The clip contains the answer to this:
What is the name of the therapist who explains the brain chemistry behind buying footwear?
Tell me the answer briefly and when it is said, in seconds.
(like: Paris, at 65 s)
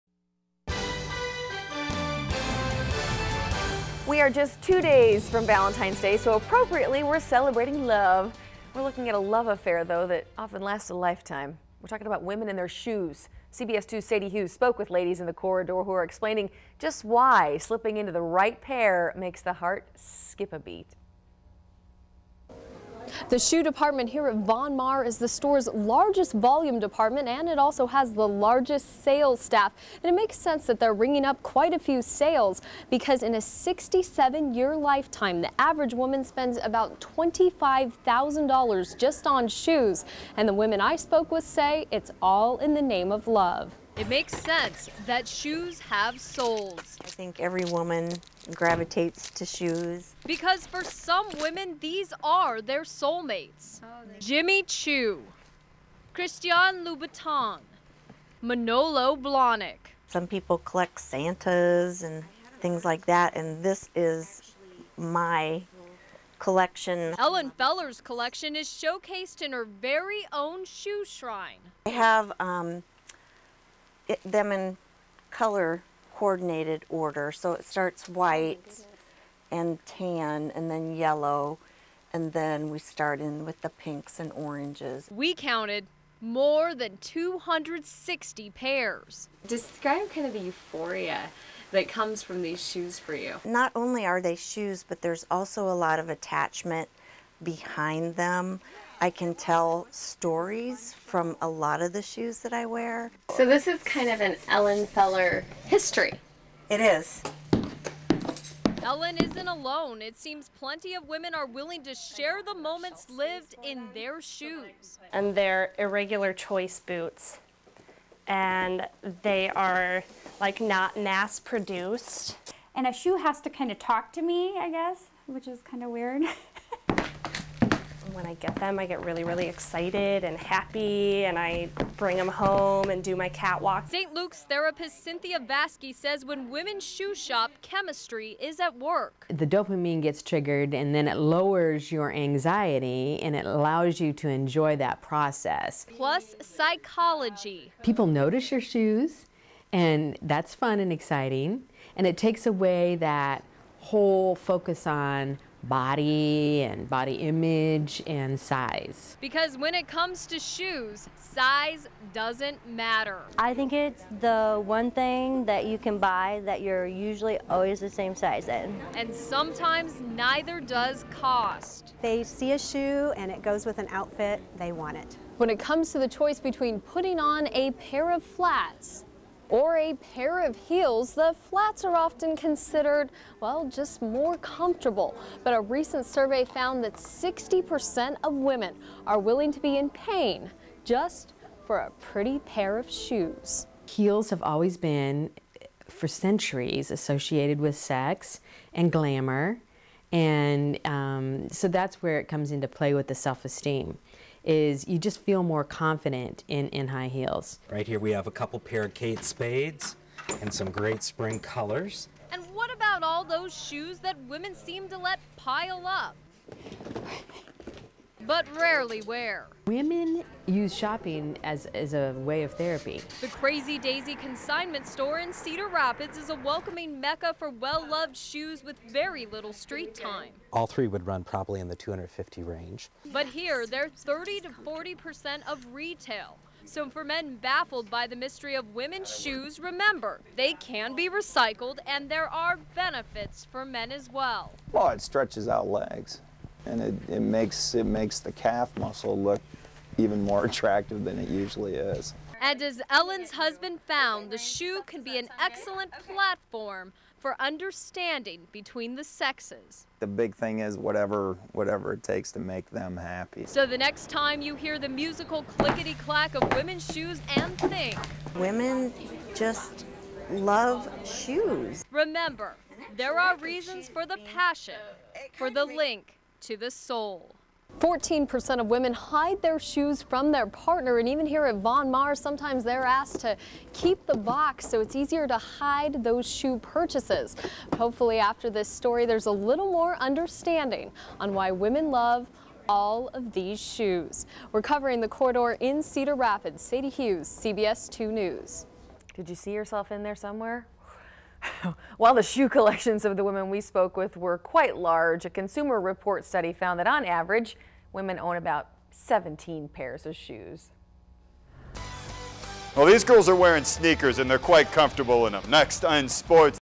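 Cynthia Vasky, at 135 s.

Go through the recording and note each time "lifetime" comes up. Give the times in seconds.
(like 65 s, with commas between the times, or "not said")
10 s, 34 s.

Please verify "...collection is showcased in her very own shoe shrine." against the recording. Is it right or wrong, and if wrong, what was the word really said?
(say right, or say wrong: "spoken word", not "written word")
right.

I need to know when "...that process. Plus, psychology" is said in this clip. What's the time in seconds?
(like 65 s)
144 s.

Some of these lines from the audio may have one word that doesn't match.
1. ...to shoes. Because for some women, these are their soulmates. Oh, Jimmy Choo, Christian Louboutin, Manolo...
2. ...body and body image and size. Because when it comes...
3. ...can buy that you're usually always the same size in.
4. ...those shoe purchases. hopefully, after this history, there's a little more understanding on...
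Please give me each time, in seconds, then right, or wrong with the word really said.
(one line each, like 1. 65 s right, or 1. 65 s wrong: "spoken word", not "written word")
1. 49 s right
2. 155 s right
3. 165 s right
4. 286 s wrong: "story", not "history".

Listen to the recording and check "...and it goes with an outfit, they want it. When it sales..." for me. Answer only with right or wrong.
wrong.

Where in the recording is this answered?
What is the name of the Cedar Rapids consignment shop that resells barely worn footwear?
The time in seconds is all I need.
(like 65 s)
223 s.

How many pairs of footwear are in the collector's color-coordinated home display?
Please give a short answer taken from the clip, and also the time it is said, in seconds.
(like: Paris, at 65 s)
more than 260, at 86 s.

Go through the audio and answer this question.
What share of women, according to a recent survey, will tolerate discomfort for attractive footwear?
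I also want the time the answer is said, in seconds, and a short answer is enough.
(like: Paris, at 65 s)
60%, at 186 s.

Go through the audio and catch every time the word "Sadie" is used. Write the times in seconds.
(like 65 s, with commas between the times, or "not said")
14 s, 296 s.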